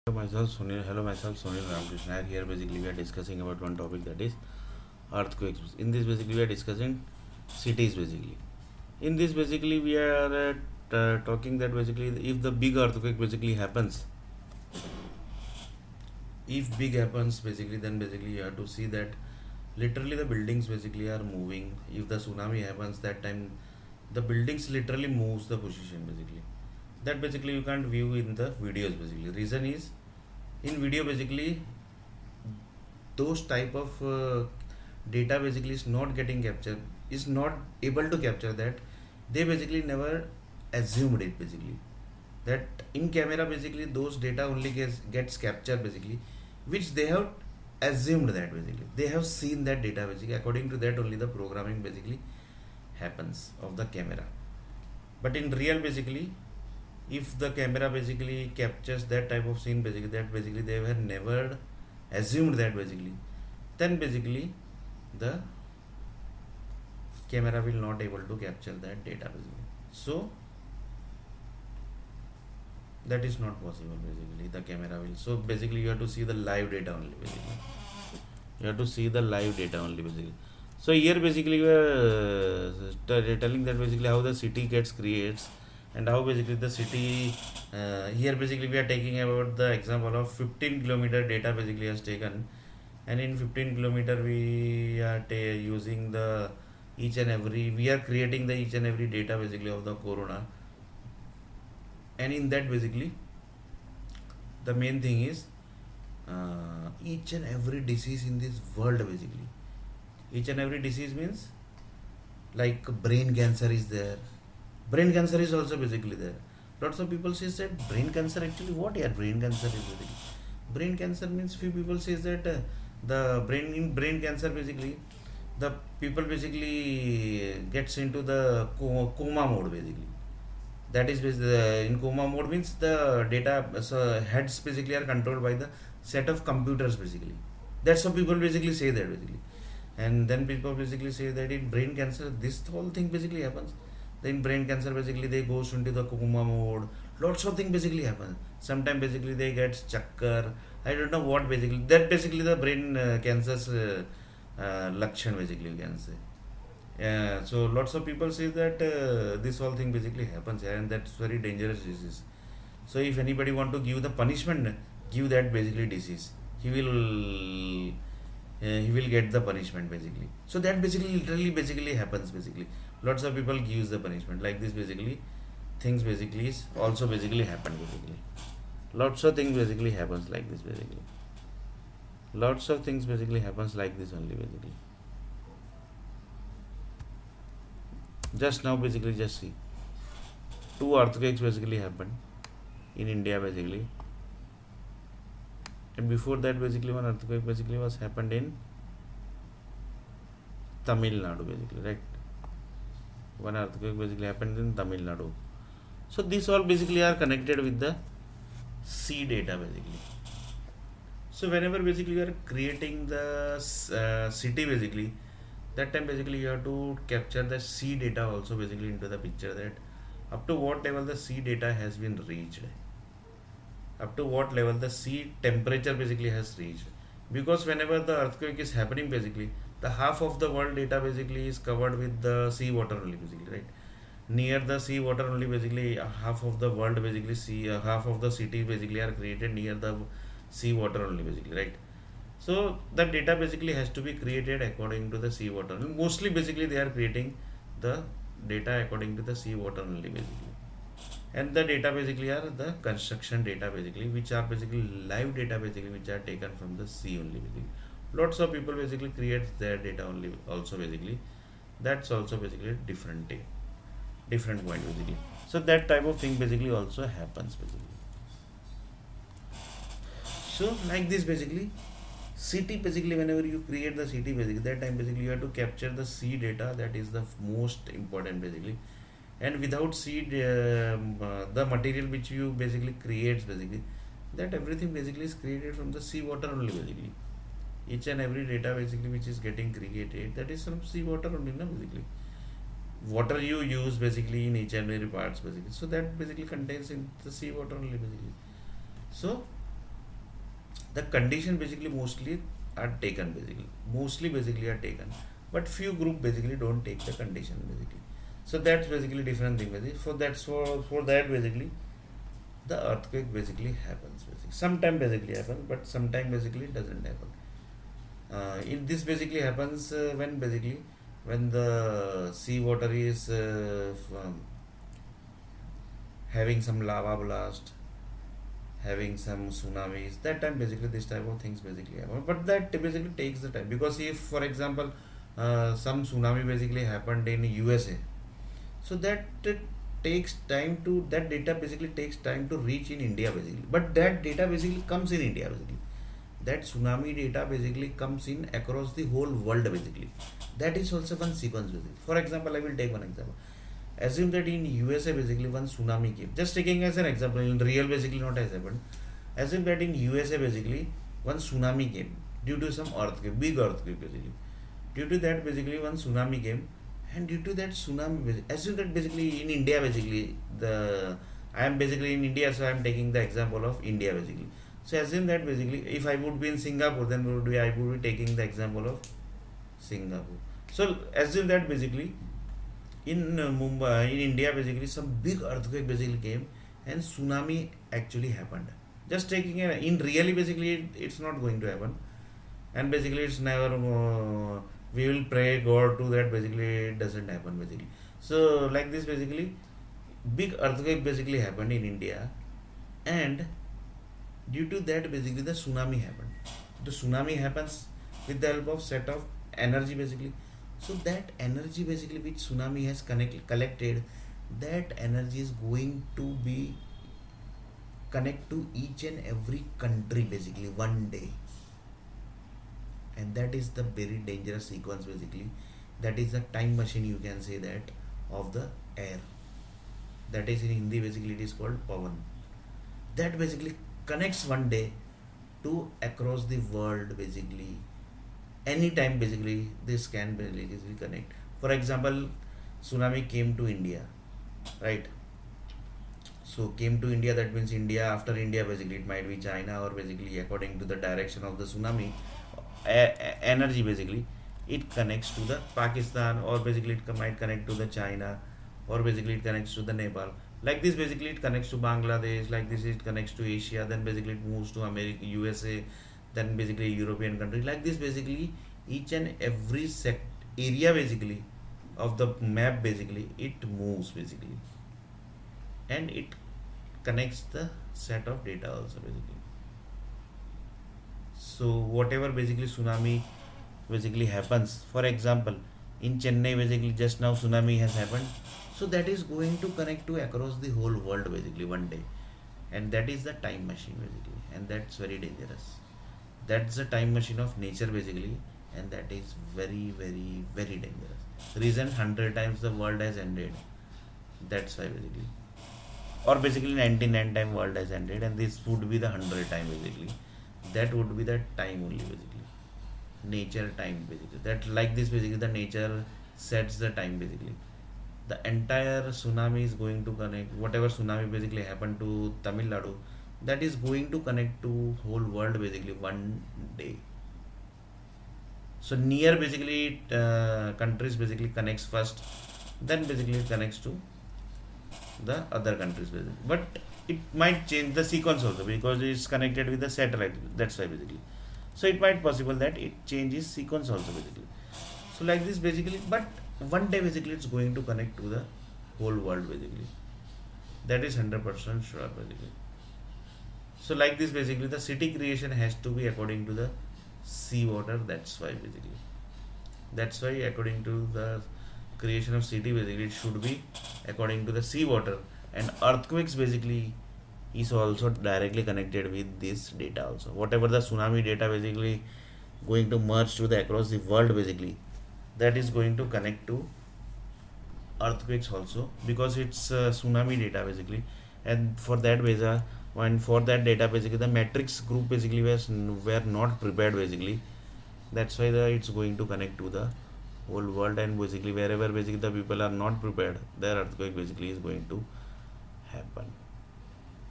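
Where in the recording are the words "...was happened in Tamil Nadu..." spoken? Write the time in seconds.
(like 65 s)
197 s.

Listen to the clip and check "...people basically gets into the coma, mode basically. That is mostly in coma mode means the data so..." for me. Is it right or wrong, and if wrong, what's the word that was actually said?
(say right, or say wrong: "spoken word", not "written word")
wrong: "basically", not "mostly".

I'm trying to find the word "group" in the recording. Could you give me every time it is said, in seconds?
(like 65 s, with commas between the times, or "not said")
306 s, 584 s.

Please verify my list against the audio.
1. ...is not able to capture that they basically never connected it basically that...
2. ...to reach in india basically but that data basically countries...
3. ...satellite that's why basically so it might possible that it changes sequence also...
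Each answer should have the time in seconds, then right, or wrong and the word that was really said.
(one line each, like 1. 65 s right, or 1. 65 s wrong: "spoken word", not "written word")
1. 37 s wrong: "assumed", not "connected"
2. 342 s wrong: "comes", not "countries"
3. 539 s right.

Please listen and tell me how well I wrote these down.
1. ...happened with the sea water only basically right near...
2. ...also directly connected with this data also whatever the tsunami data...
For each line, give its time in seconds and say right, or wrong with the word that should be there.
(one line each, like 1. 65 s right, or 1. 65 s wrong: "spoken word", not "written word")
1. 231 s wrong: "covered", not "happened"
2. 567 s right.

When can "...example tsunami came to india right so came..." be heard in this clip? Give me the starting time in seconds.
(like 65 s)
441 s.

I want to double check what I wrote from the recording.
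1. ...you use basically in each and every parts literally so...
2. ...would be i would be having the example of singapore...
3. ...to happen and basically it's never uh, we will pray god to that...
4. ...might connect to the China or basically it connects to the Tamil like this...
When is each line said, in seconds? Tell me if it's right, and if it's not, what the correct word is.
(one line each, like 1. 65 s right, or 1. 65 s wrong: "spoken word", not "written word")
1. 293 s wrong: "basically", not "literally"
2. 377 s wrong: "taking", not "having"
3. 391 s right
4. 457 s wrong: "Nepal", not "Tamil".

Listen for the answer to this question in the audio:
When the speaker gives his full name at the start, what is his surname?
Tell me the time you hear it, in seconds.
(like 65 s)
1 s.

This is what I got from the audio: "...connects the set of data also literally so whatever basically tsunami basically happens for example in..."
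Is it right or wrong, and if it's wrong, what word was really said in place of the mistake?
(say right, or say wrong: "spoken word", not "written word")
wrong: "basically", not "literally".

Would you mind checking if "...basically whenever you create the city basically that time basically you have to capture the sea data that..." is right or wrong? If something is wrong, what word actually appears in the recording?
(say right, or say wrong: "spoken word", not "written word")
right.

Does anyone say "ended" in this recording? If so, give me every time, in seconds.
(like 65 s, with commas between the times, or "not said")
503 s, 508 s.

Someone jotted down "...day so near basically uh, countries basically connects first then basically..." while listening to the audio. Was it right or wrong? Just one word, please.
right.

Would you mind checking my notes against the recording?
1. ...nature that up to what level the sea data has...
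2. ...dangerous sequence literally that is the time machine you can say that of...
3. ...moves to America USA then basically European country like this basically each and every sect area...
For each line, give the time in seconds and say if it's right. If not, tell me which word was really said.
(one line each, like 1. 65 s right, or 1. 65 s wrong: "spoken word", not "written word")
1. 219 s wrong: "picture", not "nature"
2. 424 s wrong: "basically", not "literally"
3. 464 s right.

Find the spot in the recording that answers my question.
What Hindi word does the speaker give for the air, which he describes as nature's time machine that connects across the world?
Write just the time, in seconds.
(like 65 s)
431 s.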